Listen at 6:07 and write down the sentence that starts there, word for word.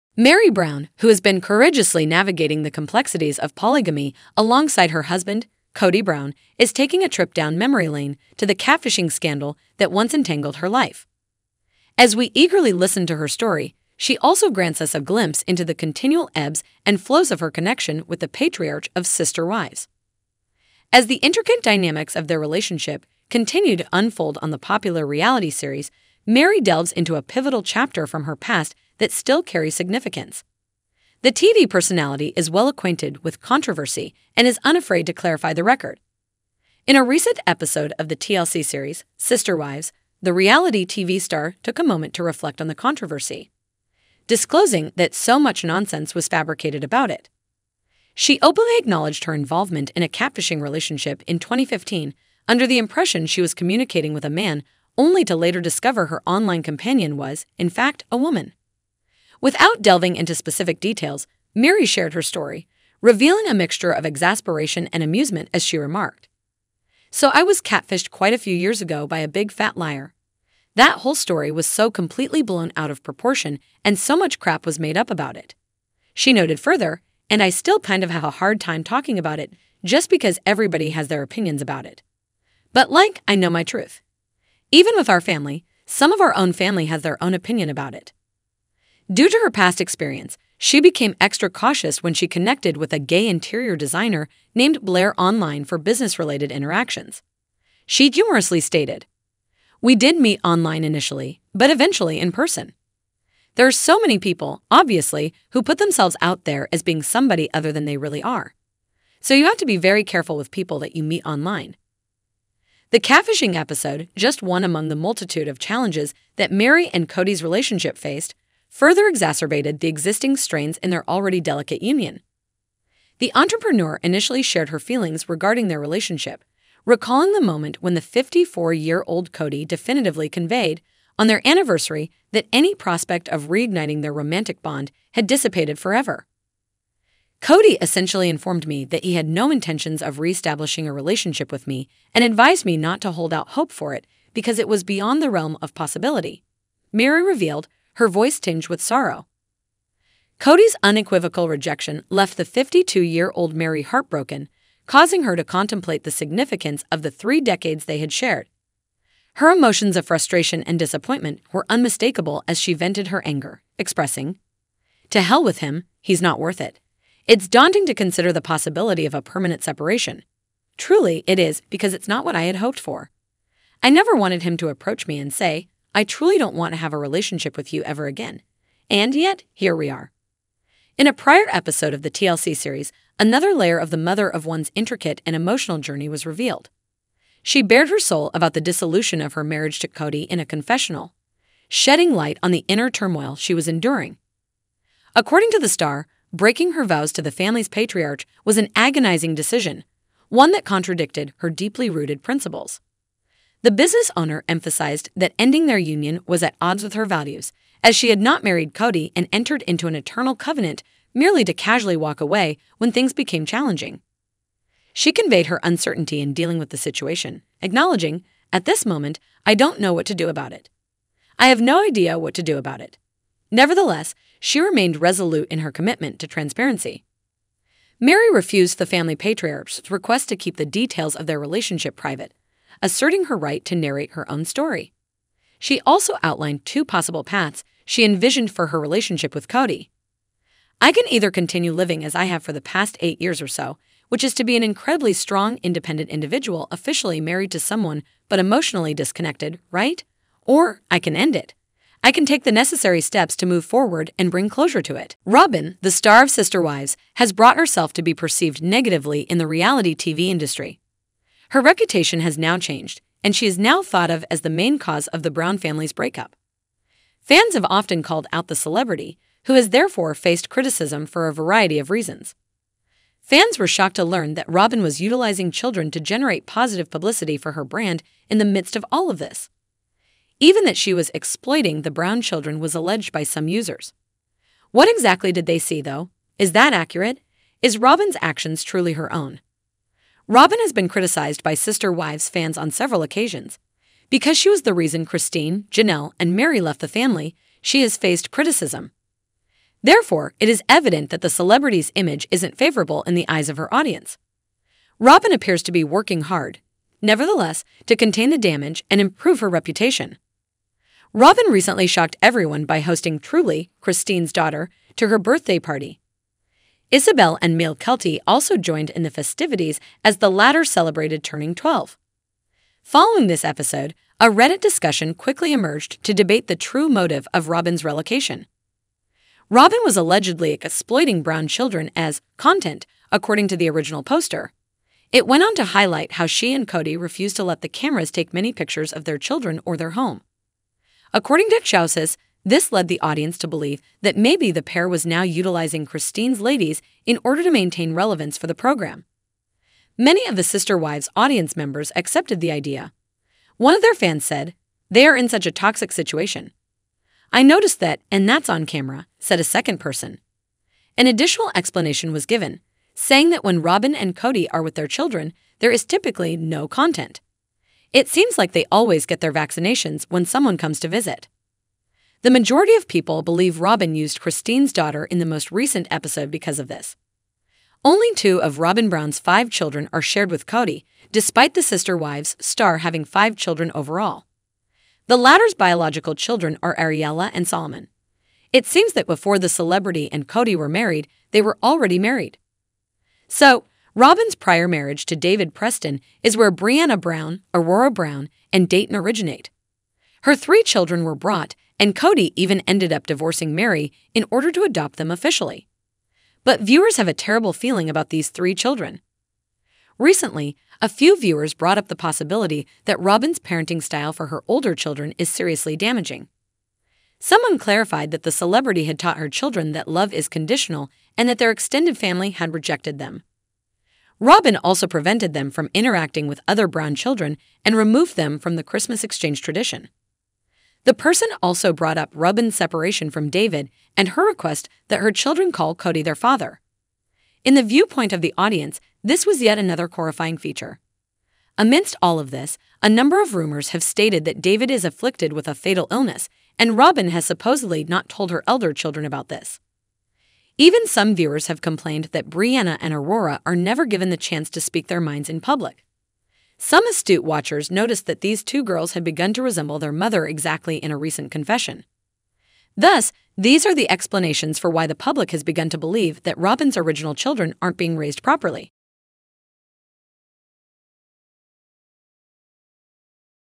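It seems like they always get their vaccinations when someone comes to visit.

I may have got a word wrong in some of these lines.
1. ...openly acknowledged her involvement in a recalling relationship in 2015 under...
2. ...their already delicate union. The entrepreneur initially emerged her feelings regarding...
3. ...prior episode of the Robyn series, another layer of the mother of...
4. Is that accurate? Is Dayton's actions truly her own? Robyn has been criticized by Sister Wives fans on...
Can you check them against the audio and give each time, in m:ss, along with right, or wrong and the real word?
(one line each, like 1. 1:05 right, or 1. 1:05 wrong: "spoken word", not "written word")
1. 0:48 wrong: "catfishing", not "recalling"
2. 2:00 wrong: "shared", not "emerged"
3. 3:01 wrong: "TLC", not "Robyn"
4. 4:46 wrong: "Robyn", not "Dayton".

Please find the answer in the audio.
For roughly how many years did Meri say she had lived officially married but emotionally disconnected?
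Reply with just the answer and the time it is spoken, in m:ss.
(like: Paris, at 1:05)
8, at 4:03.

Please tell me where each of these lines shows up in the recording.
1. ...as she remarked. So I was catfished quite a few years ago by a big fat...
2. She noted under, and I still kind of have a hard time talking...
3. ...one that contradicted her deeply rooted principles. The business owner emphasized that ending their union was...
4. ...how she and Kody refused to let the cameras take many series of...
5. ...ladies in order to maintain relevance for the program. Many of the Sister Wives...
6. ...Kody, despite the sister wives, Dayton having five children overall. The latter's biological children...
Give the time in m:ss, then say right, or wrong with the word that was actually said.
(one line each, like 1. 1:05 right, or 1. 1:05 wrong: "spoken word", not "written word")
1. 1:05 right
2. 1:16 wrong: "further", not "under"
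3. 3:20 right
4. 5:36 wrong: "pictures", not "series"
5. 5:46 right
6. 6:20 wrong: "Star", not "Dayton".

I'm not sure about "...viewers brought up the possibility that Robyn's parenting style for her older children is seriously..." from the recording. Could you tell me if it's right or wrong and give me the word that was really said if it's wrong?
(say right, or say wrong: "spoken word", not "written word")
right.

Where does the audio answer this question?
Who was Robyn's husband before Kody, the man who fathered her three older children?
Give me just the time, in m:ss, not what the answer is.
6:35.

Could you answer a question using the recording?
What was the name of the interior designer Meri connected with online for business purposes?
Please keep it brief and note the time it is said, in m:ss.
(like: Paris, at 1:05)
Blair, at 1:34.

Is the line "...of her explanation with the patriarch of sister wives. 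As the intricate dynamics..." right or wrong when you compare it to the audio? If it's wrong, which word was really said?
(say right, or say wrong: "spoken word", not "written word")
wrong: "connection", not "explanation".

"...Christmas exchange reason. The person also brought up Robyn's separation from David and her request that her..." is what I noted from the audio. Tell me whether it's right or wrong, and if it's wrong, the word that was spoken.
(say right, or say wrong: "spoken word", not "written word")
wrong: "tradition", not "reason".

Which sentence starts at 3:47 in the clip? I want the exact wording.
Meri refused the family patriarch's request to keep the details of their relationship private, asserting her right to narrate her own story.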